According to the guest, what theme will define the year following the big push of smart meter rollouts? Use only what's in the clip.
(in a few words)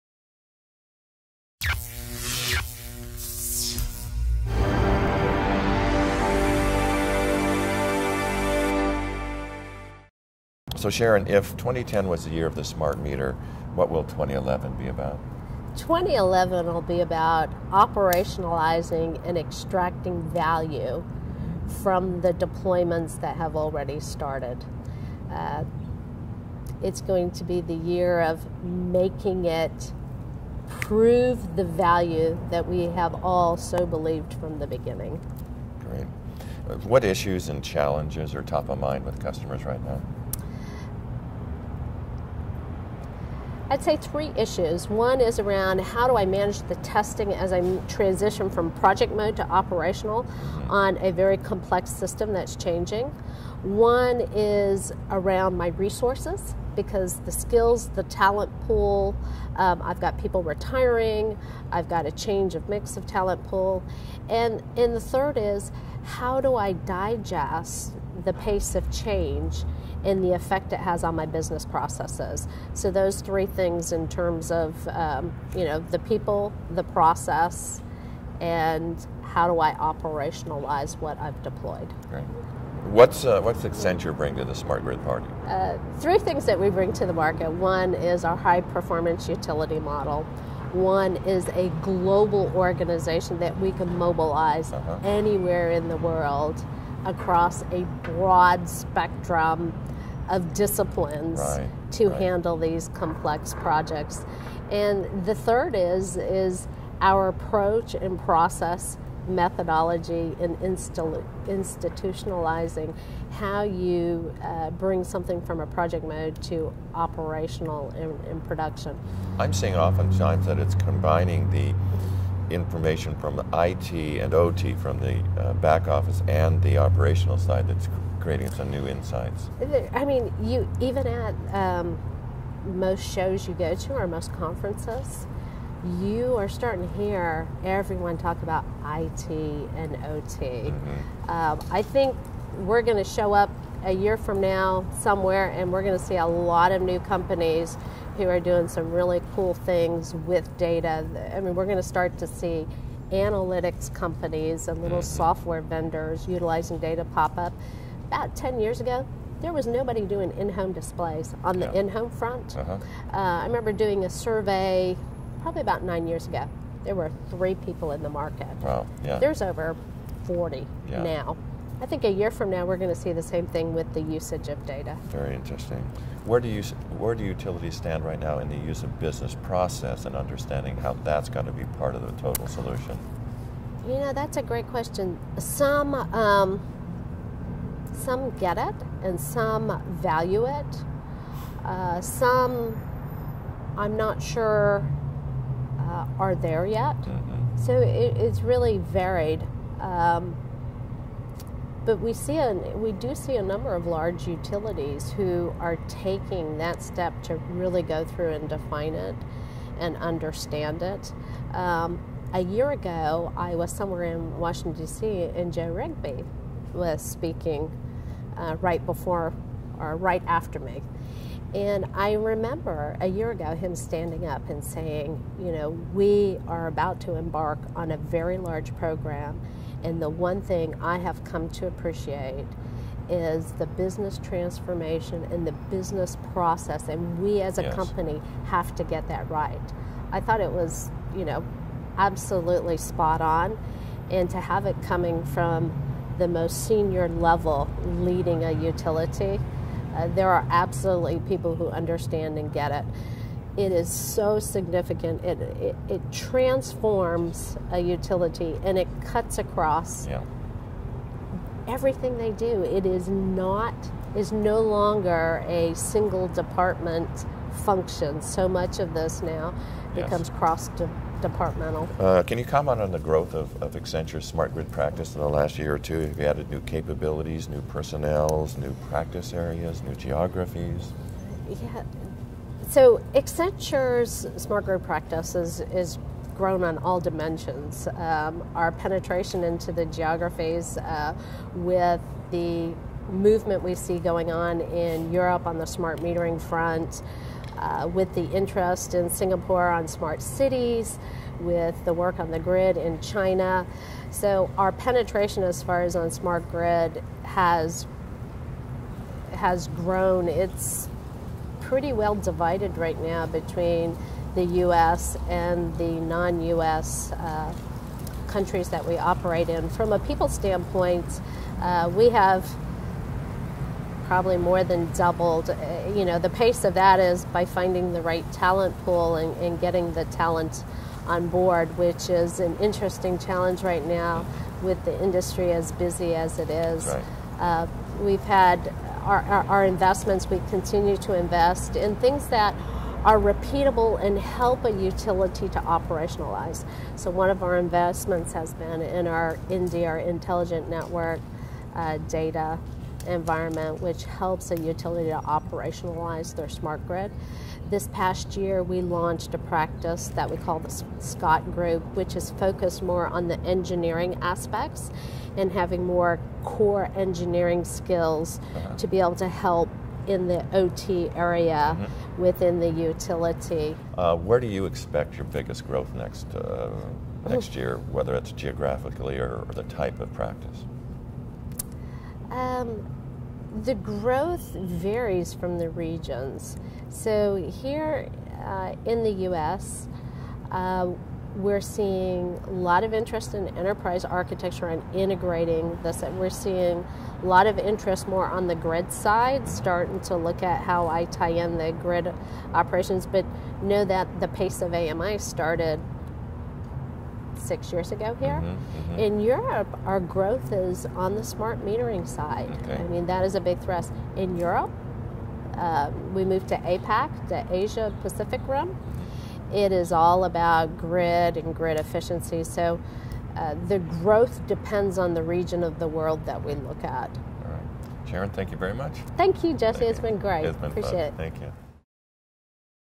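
operationalizing and extracting value.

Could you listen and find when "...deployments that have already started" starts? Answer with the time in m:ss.
0:22.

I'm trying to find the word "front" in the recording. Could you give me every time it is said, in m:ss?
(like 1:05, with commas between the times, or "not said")
2:42, 4:56.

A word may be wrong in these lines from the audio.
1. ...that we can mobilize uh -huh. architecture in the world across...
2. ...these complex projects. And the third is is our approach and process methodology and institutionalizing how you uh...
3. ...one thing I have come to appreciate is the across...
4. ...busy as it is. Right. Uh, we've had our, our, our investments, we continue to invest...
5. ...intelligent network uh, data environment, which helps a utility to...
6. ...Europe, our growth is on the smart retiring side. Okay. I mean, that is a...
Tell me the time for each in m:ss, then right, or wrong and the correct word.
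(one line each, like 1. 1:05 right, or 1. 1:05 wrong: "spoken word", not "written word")
1. 1:33 wrong: "anywhere", not "architecture"
2. 1:42 right
3. 3:50 wrong: "business", not "across"
4. 5:35 right
5. 5:49 right
6. 6:49 wrong: "metering", not "retiring".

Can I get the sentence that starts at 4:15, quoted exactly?
It, it, it transforms a utility and it cuts across yeah.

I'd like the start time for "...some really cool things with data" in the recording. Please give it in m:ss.
2:28.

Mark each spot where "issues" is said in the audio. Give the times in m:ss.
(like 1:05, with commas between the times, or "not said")
0:37, 0:44.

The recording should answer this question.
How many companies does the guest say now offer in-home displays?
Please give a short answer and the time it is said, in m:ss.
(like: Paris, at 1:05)
over 40, at 2:49.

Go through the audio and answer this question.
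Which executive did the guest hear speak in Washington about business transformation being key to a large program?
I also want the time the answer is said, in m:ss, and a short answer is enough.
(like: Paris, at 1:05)
Joe Rigby, at 3:35.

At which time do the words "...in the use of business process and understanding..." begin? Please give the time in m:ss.
2:58.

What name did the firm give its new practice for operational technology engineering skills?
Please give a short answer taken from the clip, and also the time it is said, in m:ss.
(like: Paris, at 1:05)
Scott Group, at 6:00.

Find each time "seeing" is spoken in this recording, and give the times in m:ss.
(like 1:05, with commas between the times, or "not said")
1:59, 6:31, 6:36.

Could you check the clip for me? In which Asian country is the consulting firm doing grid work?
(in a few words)
China.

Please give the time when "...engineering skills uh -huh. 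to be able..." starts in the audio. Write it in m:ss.
6:06.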